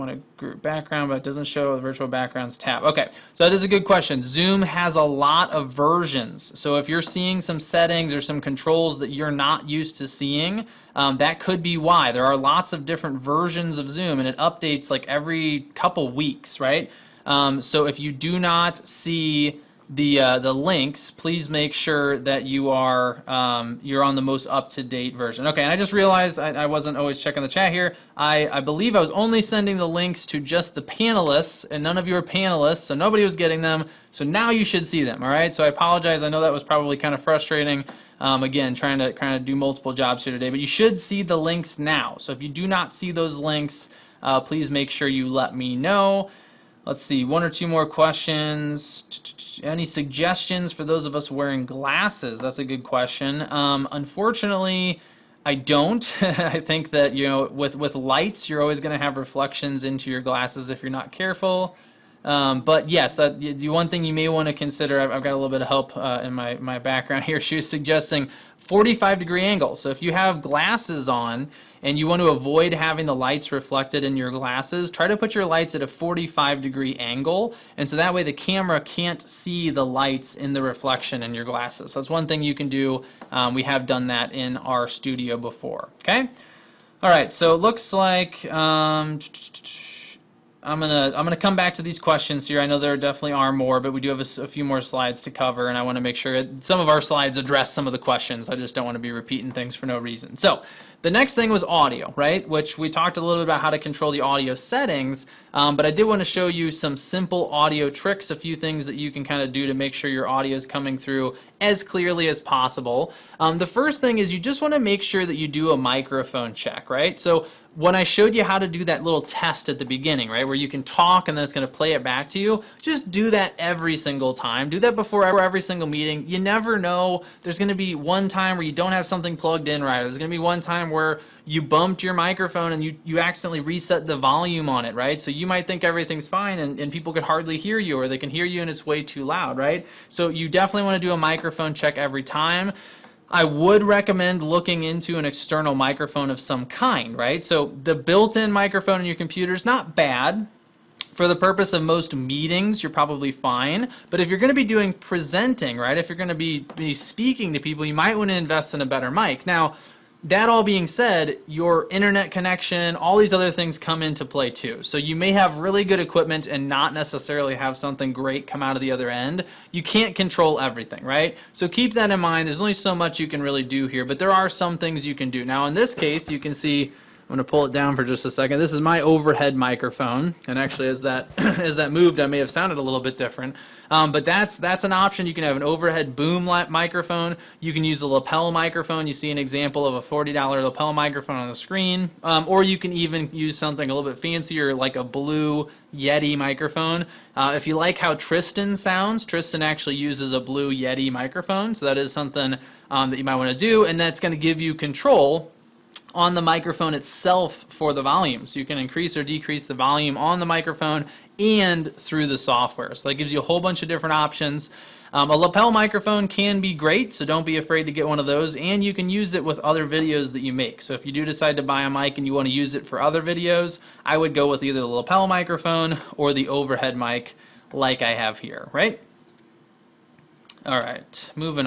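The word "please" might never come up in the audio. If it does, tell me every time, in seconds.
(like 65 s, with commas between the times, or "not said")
21 s, 44 s.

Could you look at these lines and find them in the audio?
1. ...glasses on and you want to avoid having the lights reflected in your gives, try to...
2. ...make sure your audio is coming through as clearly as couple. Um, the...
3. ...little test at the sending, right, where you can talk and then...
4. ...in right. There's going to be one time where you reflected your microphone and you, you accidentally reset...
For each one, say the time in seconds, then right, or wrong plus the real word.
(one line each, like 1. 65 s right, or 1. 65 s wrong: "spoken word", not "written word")
1. 70 s wrong: "glasses", not "gives"
2. 109 s wrong: "possible", not "couple"
3. 119 s wrong: "beginning", not "sending"
4. 129 s wrong: "bumped", not "reflected".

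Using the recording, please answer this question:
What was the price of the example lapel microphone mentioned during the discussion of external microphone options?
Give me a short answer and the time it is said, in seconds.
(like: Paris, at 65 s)
$40, at 190 s.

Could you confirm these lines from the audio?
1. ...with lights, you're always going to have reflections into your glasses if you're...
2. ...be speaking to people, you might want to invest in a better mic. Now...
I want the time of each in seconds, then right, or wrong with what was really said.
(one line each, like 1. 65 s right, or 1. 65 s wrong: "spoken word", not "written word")
1. 57 s right
2. 156 s right.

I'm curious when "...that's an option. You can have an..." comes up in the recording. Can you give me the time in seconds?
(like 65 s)
184 s.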